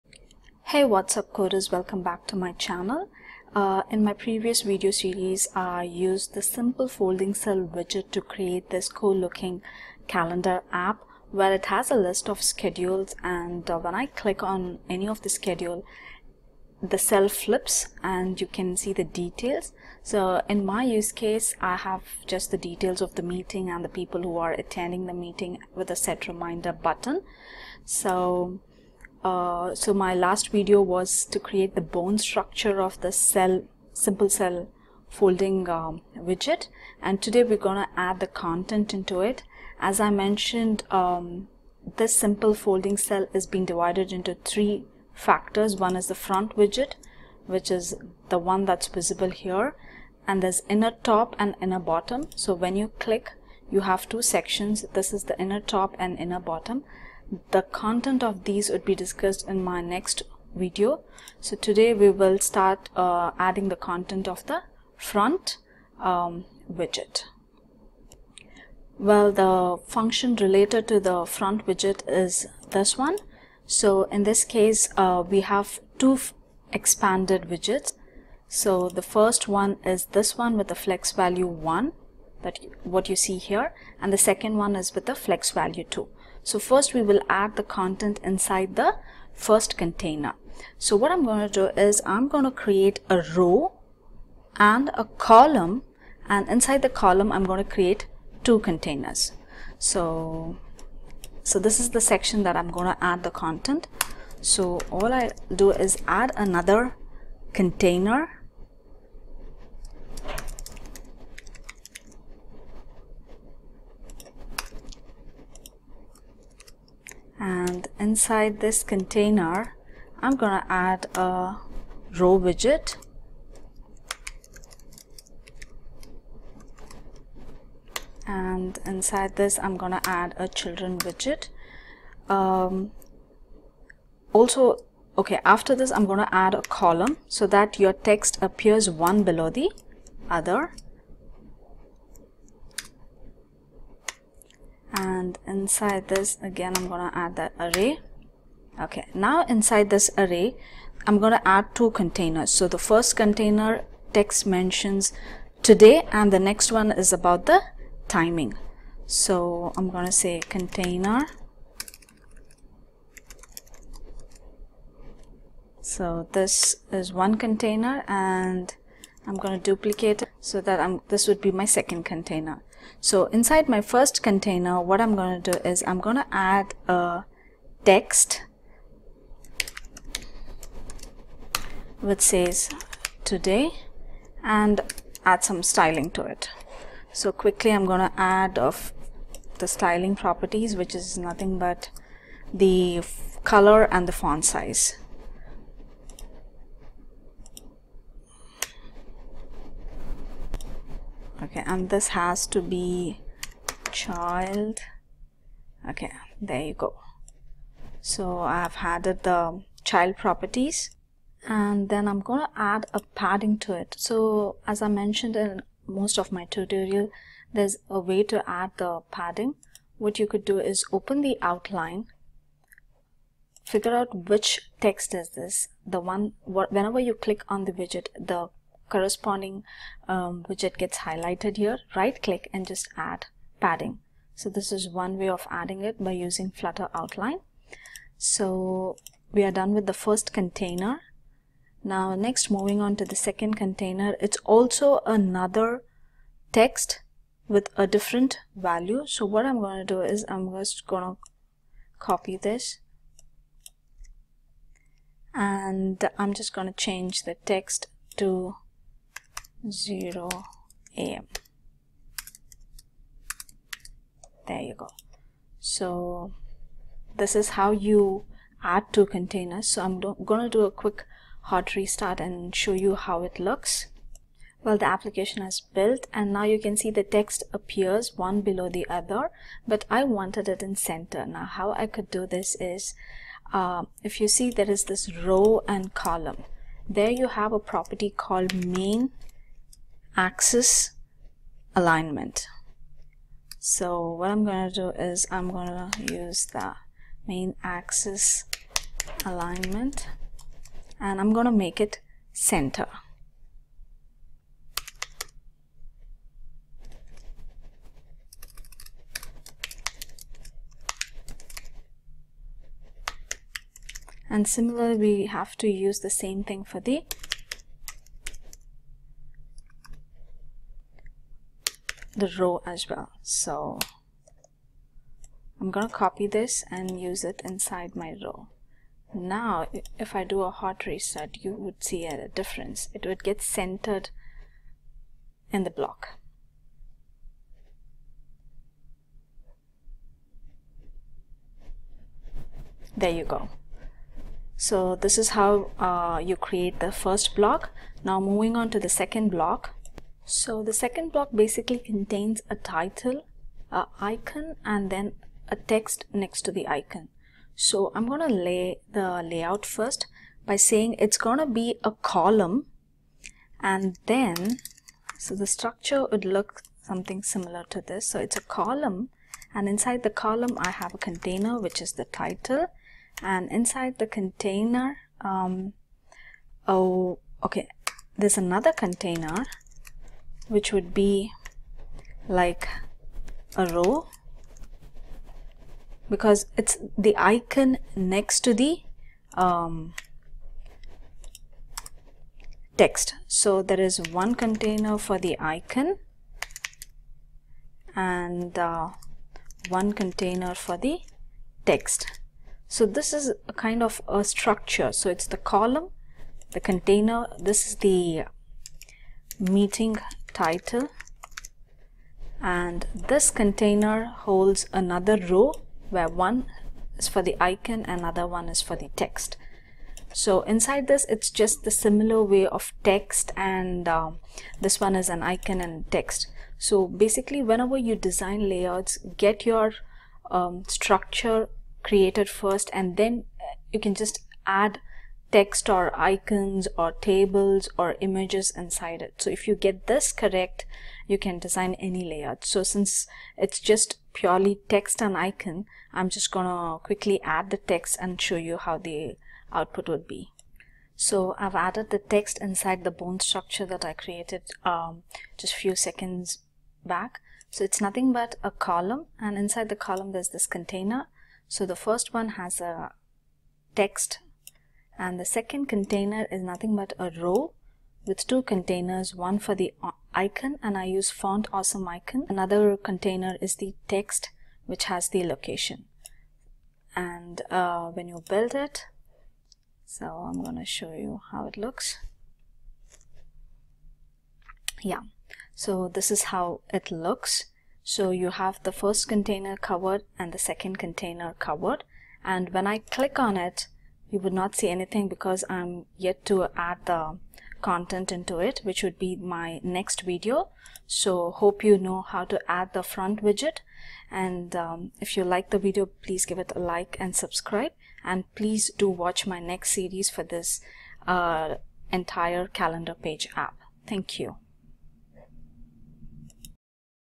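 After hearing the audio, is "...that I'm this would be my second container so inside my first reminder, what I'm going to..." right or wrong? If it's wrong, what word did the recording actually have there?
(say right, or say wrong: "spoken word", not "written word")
wrong: "container", not "reminder".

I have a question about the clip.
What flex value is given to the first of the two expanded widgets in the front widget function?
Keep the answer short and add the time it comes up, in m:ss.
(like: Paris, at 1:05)
1, at 1:20.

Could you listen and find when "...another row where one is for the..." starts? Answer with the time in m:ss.
6:54.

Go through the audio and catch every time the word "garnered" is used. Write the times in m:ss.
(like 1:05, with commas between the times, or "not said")
not said.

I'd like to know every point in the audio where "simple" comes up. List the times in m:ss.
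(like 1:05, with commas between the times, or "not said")
0:06, 0:33, 0:42.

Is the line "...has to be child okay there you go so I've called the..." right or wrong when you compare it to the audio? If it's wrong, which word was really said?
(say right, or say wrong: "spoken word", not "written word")
wrong: "added", not "called".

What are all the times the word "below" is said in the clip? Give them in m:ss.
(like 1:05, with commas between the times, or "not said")
2:19, 4:38.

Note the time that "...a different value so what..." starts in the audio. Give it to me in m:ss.
4:07.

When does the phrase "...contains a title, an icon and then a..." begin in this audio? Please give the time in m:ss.
5:51.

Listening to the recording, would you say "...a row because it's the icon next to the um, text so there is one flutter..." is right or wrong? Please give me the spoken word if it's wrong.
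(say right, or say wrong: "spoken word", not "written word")
wrong: "container", not "flutter".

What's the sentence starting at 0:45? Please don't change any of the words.
One is the front widget, which is the one that's visible here.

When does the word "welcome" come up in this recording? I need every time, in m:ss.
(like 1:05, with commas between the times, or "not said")
0:01.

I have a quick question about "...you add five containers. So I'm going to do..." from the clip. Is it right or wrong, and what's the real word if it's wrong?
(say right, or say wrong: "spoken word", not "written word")
wrong: "two", not "five".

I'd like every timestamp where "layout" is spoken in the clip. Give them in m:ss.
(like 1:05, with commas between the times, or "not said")
5:59, 7:08, 7:22.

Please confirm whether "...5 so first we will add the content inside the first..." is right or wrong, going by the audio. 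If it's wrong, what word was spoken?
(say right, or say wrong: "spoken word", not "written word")
wrong: "2", not "5".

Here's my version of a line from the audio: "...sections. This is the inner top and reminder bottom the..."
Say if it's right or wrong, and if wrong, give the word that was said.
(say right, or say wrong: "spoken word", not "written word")
wrong: "inner", not "reminder".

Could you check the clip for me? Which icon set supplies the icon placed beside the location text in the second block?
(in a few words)
font awesome.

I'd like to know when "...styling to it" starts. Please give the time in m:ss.
3:05.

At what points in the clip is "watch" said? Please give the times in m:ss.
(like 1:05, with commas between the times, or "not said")
8:28.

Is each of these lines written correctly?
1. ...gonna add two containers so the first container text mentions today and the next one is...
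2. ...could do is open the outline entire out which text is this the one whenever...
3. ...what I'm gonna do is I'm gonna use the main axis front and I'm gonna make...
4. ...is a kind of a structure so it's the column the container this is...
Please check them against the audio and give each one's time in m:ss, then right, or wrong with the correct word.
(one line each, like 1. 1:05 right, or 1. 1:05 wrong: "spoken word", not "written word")
1. 2:31 right
2. 3:40 wrong: "figure", not "entire"
3. 4:54 wrong: "alignment", not "front"
4. 6:43 right.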